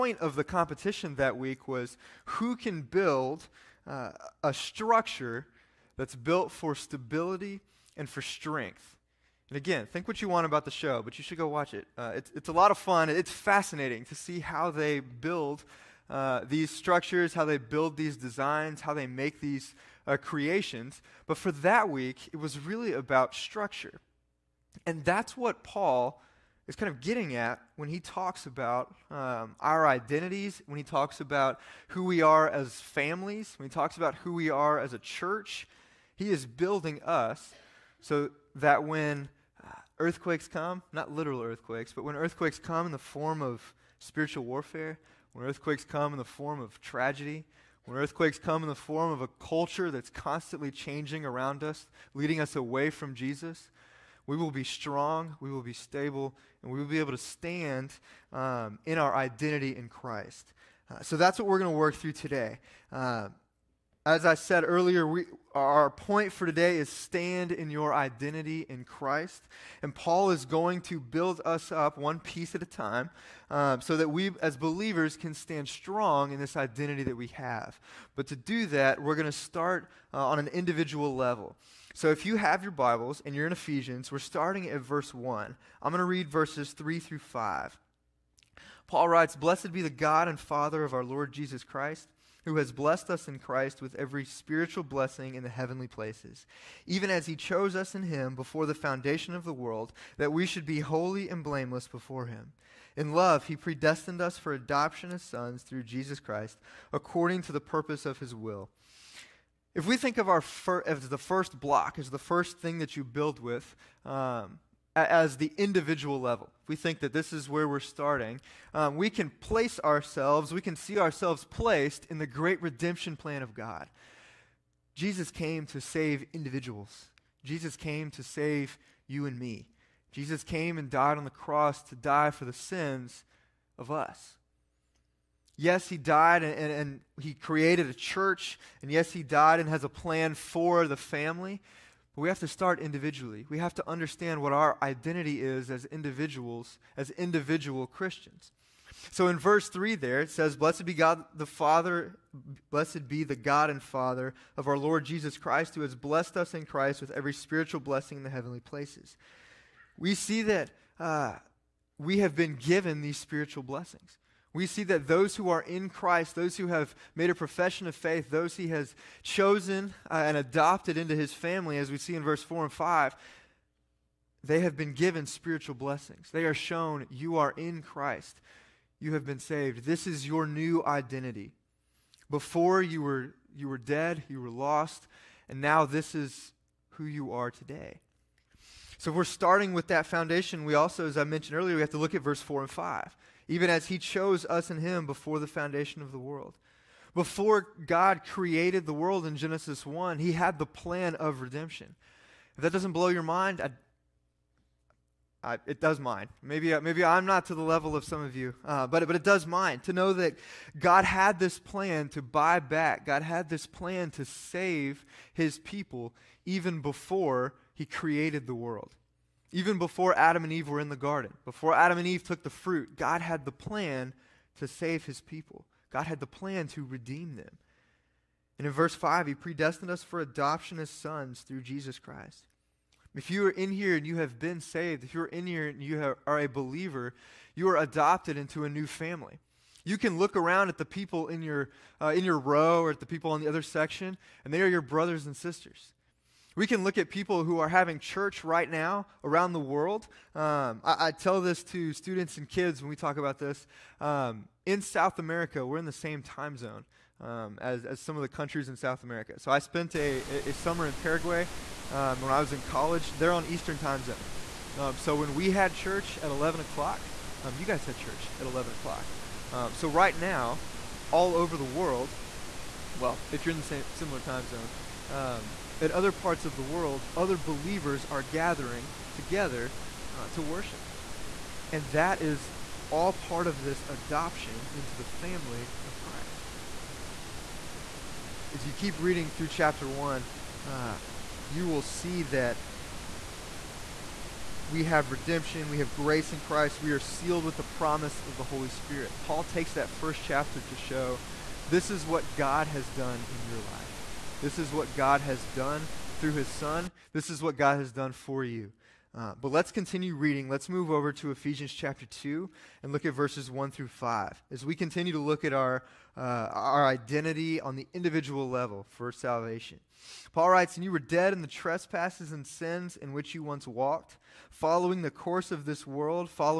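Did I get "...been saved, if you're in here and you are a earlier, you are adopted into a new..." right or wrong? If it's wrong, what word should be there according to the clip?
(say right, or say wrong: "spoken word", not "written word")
wrong: "believer", not "earlier".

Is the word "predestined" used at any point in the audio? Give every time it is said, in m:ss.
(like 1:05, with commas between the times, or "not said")
1:43, 3:49.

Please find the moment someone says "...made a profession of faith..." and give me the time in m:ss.
2:47.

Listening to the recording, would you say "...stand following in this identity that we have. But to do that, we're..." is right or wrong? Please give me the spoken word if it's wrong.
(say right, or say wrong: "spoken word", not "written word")
wrong: "strong", not "following".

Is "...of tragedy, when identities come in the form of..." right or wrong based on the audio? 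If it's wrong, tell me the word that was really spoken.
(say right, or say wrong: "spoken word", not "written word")
wrong: "earthquakes", not "identities".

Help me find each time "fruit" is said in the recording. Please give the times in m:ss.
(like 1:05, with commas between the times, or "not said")
3:42.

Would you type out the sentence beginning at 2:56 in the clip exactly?
They are shown, You are in Christ.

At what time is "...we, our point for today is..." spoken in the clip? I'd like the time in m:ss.
1:05.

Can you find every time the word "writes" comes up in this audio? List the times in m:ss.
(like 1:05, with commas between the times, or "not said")
1:29, 5:20.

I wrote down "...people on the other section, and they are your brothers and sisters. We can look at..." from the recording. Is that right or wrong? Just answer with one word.
right.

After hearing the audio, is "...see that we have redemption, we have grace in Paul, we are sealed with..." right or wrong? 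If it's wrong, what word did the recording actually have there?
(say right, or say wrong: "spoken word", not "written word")
wrong: "Christ", not "Paul".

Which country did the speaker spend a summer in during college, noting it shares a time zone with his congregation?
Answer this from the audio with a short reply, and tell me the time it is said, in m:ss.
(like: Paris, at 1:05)
Paraguay, at 4:20.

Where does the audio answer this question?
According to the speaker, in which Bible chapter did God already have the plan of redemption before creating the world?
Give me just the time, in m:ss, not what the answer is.
3:19.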